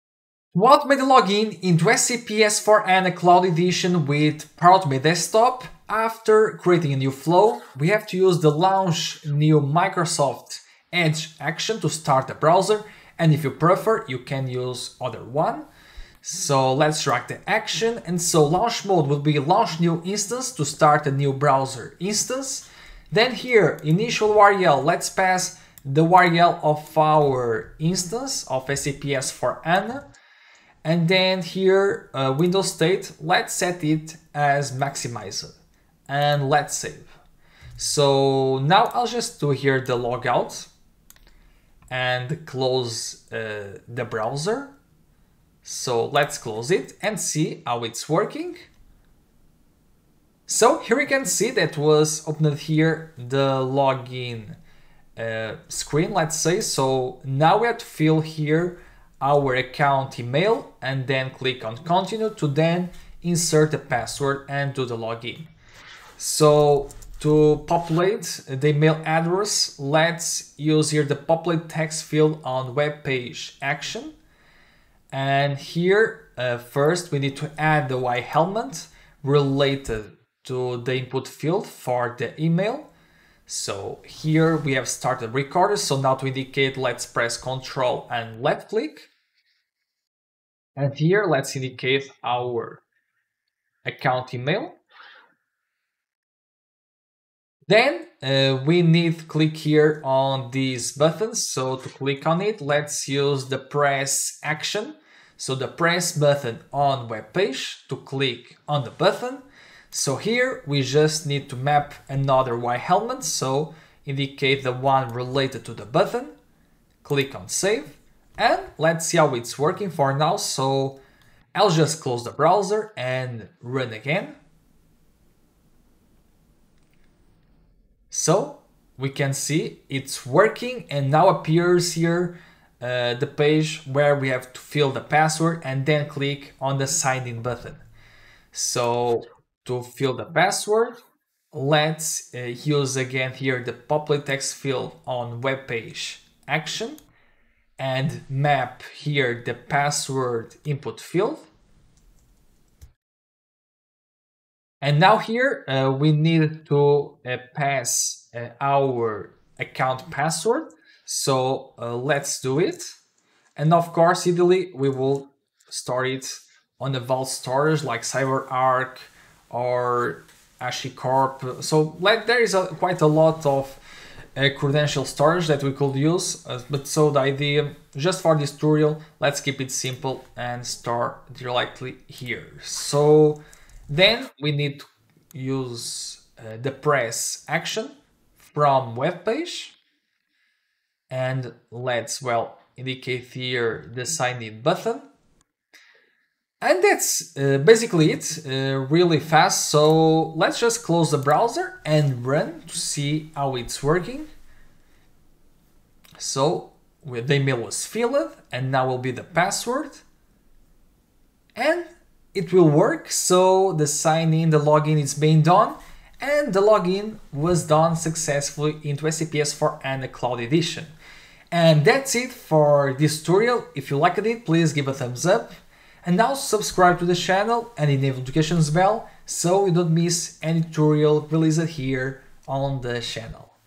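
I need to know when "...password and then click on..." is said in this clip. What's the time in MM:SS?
02:15.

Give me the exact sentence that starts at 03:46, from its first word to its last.
And now subscribe to the channel and enable notifications bell so you don't miss any tutorial released here on the channel.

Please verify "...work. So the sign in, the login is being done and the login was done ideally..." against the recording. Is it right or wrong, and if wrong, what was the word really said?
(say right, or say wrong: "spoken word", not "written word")
wrong: "successfully", not "ideally".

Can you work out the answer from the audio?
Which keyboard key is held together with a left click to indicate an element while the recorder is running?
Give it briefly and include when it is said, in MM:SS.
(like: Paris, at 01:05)
Control, at 01:27.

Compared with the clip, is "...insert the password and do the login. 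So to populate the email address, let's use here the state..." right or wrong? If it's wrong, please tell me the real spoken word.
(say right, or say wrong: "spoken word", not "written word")
wrong: "populate", not "state".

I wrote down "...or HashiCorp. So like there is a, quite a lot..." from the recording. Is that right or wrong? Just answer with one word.
right.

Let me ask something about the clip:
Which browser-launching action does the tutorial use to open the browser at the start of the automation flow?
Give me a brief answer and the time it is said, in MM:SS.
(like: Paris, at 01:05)
Launch new Microsoft Edge, at 00:08.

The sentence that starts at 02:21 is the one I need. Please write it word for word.
Let's uh, use again here the populate text field on web page action and map here the password input field.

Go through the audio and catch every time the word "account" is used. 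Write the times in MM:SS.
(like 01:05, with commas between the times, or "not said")
00:59, 01:33, 02:39.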